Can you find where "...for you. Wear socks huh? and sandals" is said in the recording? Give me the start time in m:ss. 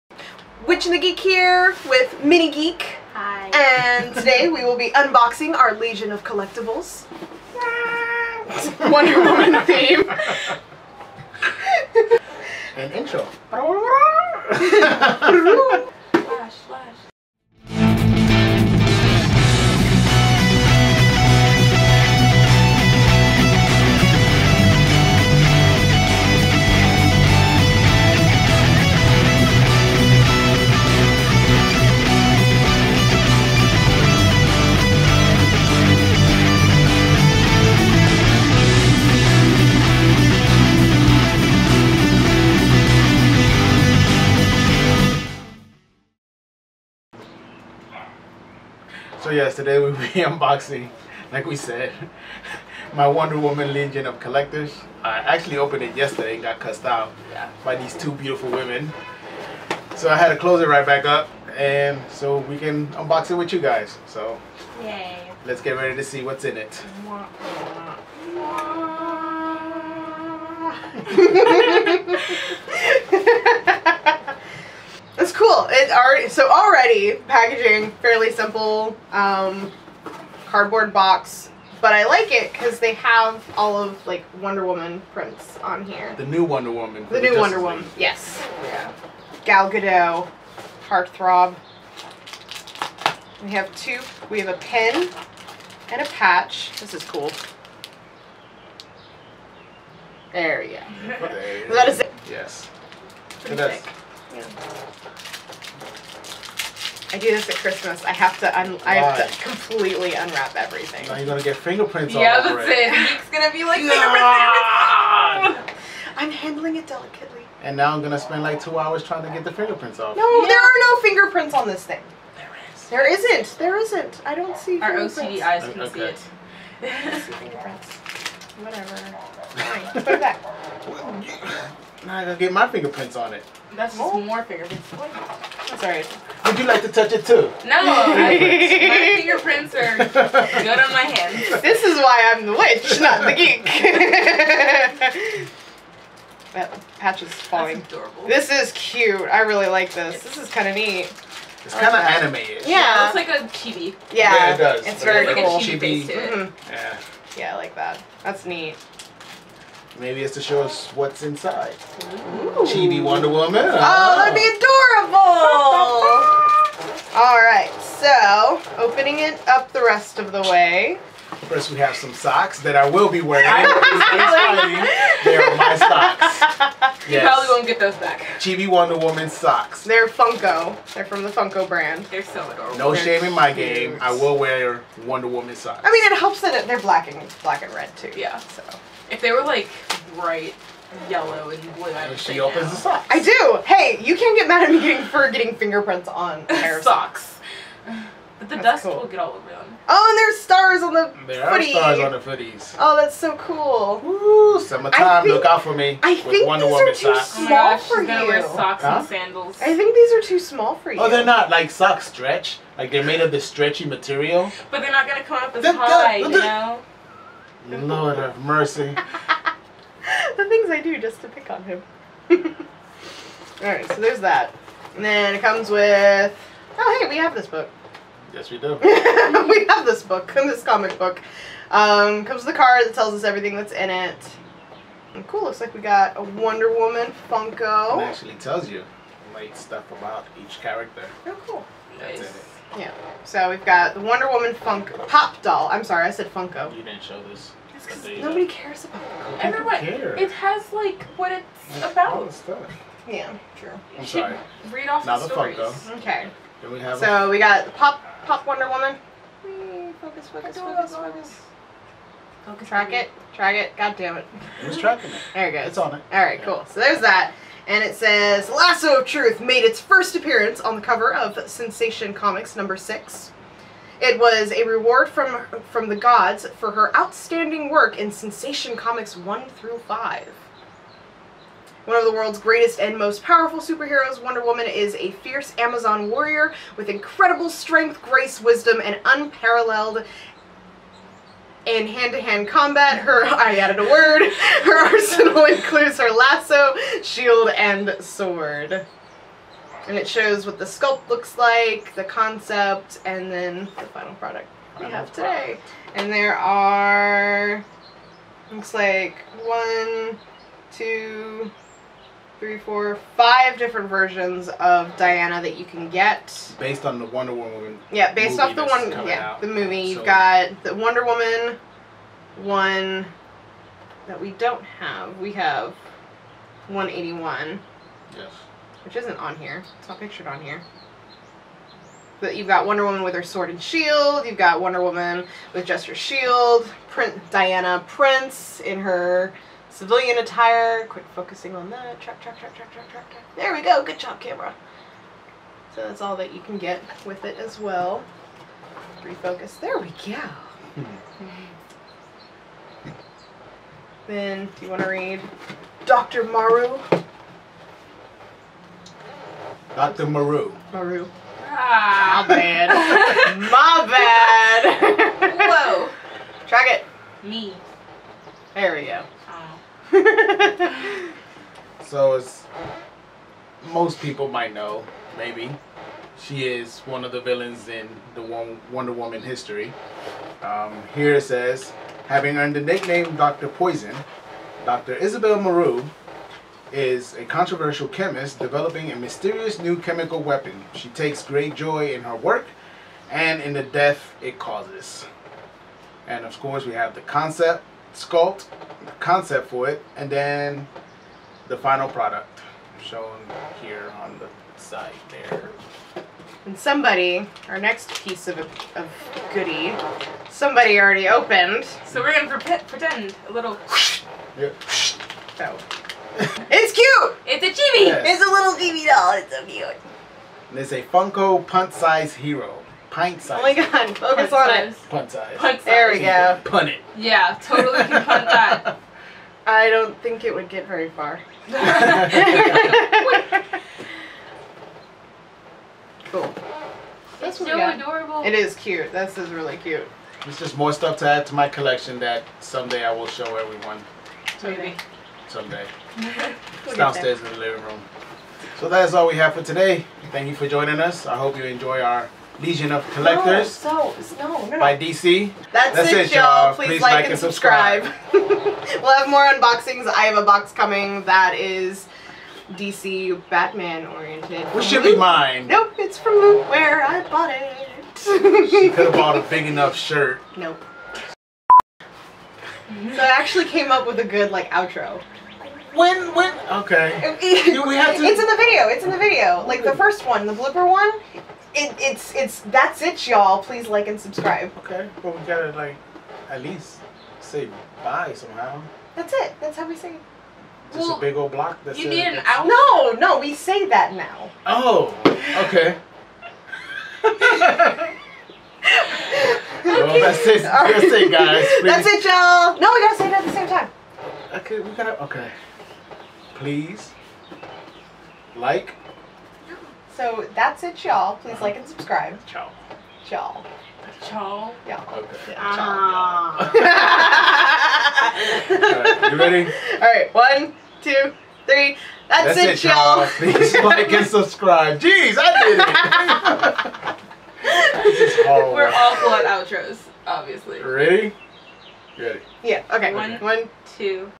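3:27.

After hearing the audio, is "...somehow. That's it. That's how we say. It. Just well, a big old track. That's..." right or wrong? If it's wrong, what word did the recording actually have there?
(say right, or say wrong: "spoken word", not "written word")
wrong: "block", not "track".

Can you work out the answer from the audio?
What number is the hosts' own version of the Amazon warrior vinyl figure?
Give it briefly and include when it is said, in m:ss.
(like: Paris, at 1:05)
181, at 5:26.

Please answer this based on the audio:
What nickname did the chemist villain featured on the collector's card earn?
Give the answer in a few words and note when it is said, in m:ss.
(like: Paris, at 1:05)
Dr. Poison, at 6:23.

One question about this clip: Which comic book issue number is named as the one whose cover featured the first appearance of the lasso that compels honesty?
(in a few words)
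6.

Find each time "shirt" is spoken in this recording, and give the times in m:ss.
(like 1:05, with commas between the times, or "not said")
7:49.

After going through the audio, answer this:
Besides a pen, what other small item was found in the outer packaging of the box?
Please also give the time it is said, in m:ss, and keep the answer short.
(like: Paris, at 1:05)
A patch, at 1:36.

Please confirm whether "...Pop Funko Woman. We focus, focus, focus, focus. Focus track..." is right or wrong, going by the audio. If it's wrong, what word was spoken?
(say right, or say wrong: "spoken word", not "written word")
wrong: "Wonder", not "Funko".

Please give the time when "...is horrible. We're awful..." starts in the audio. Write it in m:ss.
8:47.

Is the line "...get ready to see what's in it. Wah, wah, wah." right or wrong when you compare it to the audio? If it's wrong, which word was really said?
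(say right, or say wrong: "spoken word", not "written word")
right.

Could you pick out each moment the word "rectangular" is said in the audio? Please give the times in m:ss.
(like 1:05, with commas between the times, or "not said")
not said.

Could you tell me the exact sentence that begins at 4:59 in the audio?
And it shows what the sculpt looks like, the concept, and then the final product we have today.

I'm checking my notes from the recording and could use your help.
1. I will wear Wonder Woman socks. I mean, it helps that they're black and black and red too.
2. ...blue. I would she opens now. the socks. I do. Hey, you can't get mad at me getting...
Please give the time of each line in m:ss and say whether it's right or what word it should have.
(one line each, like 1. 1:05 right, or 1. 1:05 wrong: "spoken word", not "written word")
1. 3:03 right
2. 3:11 right.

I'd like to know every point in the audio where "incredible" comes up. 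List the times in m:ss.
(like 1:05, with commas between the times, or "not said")
4:46.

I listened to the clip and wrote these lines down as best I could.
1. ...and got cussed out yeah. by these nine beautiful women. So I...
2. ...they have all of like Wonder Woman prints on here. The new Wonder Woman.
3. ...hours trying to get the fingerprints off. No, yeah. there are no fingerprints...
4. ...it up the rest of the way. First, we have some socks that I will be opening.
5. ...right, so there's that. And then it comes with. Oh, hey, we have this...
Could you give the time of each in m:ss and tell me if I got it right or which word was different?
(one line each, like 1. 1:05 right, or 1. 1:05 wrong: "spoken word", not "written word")
1. 0:56 wrong: "two", not "nine"
2. 1:22 right
3. 1:58 right
4. 2:49 wrong: "wearing", not "opening"
5. 3:43 right.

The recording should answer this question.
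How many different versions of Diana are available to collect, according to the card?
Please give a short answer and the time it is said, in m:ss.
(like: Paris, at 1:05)
5, at 5:13.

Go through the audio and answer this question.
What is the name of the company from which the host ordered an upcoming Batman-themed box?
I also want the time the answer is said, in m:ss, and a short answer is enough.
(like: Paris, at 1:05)
Lootwear, at 7:46.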